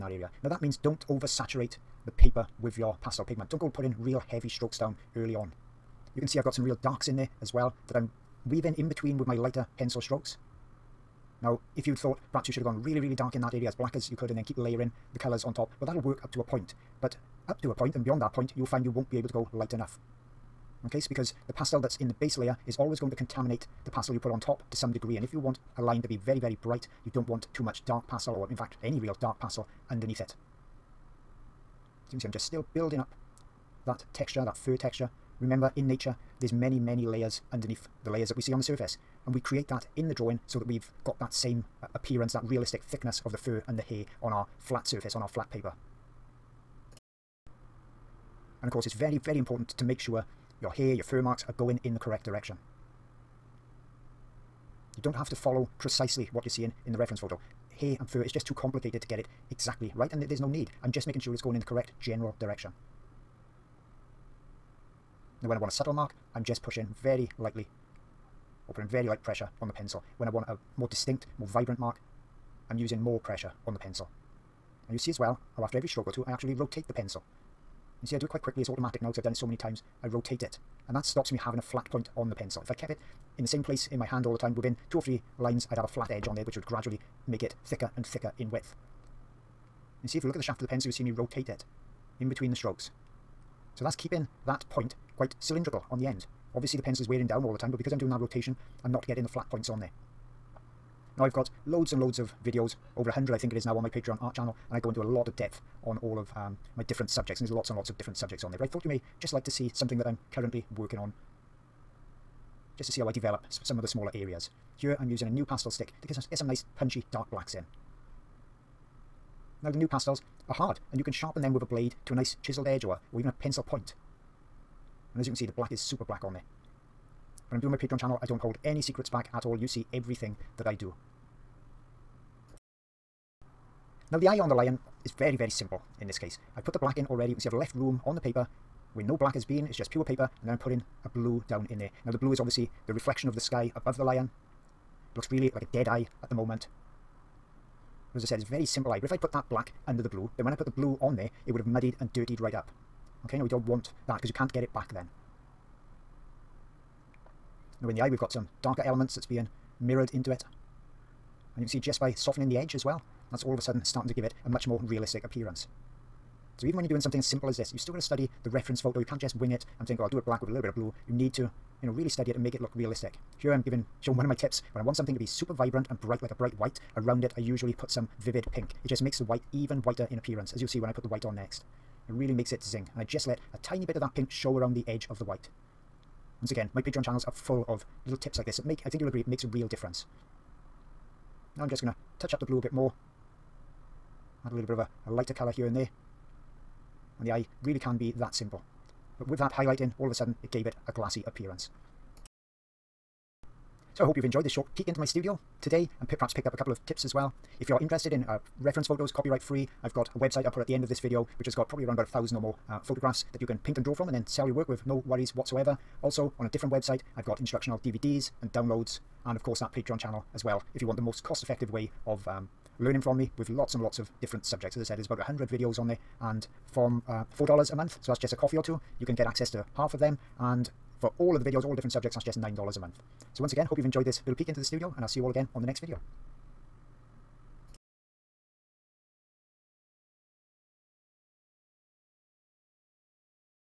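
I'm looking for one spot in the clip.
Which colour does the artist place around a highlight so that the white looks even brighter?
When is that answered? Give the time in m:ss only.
2:58.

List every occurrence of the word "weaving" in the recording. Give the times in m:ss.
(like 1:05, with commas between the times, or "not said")
0:08.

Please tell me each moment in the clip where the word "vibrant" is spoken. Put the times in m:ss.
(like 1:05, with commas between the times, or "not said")
1:11, 2:55.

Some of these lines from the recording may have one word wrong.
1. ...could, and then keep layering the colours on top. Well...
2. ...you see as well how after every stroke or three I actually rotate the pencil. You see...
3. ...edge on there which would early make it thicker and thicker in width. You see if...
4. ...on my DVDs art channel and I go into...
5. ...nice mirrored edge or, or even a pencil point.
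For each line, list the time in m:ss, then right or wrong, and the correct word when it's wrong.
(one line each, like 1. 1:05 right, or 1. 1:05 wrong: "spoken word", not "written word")
1. 0:14 right
2. 1:14 wrong: "two", not "three"
3. 1:26 wrong: "gradually", not "early"
4. 1:43 wrong: "Patreon", not "DVDs"
5. 2:02 wrong: "chiseled", not "mirrored".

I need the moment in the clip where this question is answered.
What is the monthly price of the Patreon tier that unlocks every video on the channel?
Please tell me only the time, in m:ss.
3:52.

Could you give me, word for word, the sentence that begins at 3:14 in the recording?
Add a little bit of a, a lighter colour here and there.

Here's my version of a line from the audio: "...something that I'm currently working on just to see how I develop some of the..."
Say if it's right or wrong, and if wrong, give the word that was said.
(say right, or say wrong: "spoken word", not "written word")
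right.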